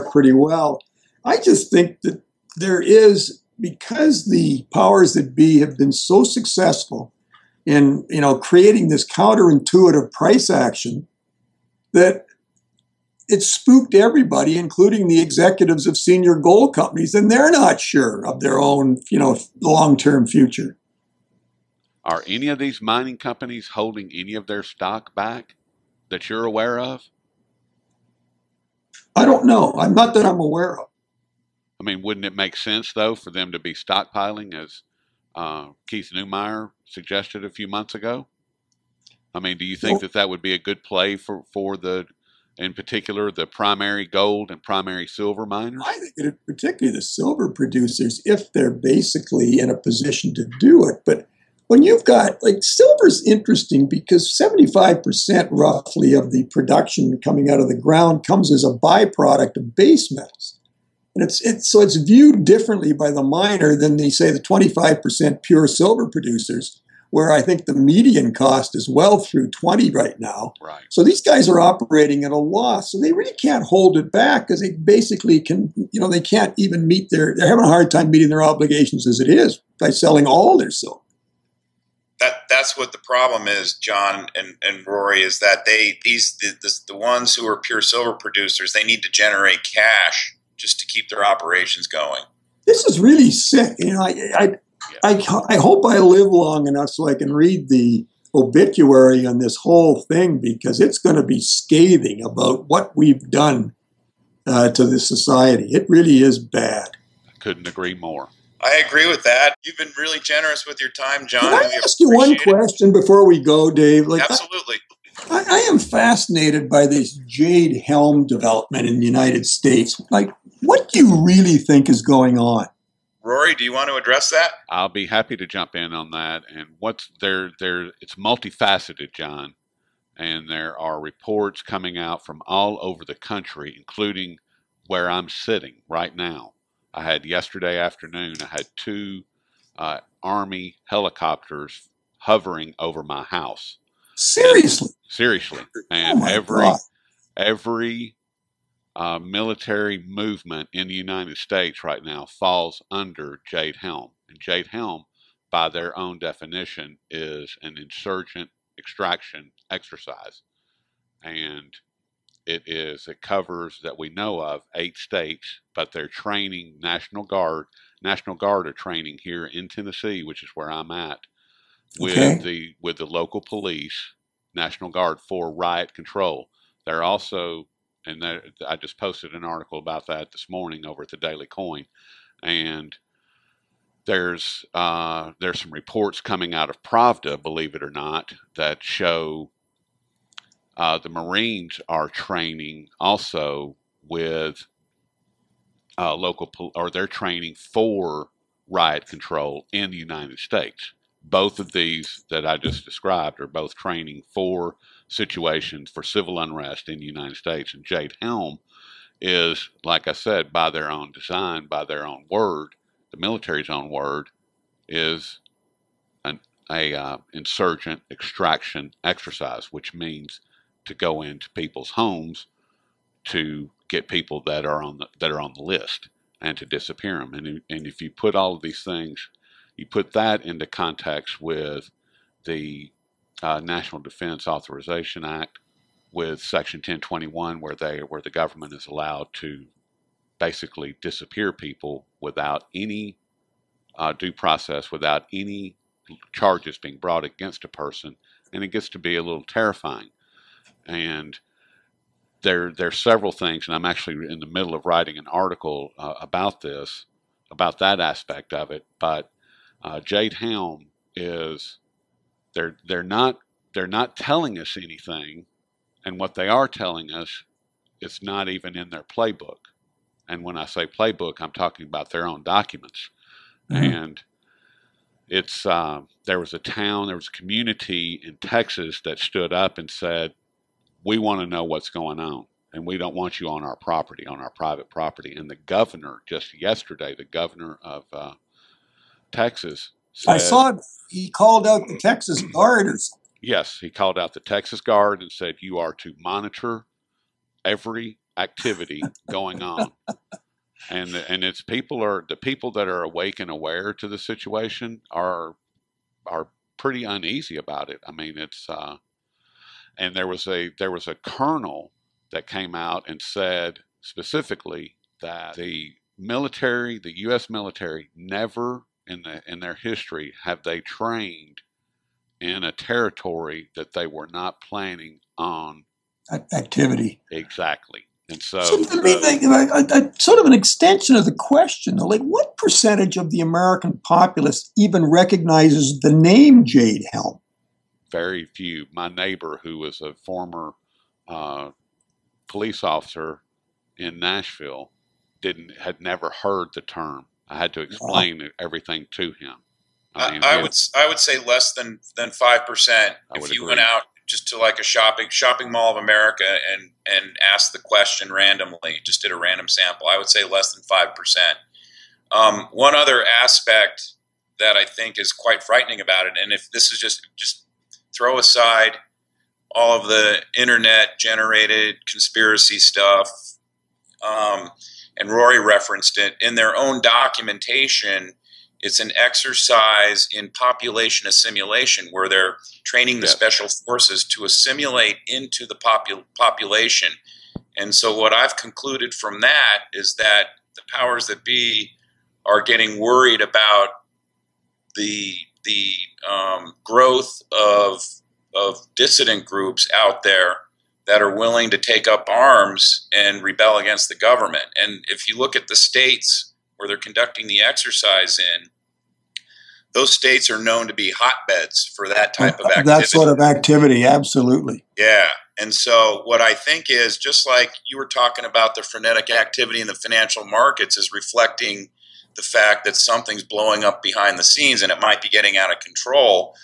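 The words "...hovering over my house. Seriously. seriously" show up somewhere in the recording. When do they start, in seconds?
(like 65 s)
142 s.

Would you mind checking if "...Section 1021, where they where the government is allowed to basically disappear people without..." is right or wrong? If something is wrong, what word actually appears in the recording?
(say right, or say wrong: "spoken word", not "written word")
right.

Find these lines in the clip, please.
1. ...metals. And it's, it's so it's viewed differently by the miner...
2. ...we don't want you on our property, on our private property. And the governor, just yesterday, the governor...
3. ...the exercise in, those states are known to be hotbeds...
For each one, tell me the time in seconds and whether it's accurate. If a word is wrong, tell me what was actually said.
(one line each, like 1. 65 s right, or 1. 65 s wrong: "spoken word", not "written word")
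1. 60 s right
2. 282 s right
3. 407 s right.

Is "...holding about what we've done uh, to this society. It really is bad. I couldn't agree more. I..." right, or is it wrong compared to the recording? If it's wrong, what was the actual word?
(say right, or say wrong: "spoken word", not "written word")
wrong: "scathing", not "holding".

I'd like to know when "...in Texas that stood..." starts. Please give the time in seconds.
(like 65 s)
278 s.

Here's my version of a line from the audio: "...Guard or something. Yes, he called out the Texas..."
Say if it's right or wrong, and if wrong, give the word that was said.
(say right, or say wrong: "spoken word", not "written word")
right.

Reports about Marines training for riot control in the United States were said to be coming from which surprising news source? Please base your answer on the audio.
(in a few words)
Pravda.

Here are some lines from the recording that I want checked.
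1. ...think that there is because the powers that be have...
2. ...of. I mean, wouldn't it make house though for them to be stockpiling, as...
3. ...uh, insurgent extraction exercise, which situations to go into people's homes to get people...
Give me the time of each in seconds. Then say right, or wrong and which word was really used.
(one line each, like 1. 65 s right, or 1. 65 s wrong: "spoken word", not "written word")
1. 1 s right
2. 30 s wrong: "sense", not "house"
3. 216 s wrong: "means", not "situations".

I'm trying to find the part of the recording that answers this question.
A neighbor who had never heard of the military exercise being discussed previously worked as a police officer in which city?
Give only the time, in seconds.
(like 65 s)
344 s.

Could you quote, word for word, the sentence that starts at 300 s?
and and it's people are the people that are awake and aware to the situation are are pretty uneasy about it.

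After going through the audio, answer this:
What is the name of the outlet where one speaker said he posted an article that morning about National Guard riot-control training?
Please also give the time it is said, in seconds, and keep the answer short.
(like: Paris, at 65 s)
The Daily Coin, at 181 s.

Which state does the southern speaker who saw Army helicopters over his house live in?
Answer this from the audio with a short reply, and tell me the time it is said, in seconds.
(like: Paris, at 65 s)
Tennessee, at 169 s.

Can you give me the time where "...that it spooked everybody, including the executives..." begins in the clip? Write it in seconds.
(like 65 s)
11 s.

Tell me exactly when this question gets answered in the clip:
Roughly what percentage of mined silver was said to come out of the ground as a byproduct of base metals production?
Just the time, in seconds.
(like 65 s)
54 s.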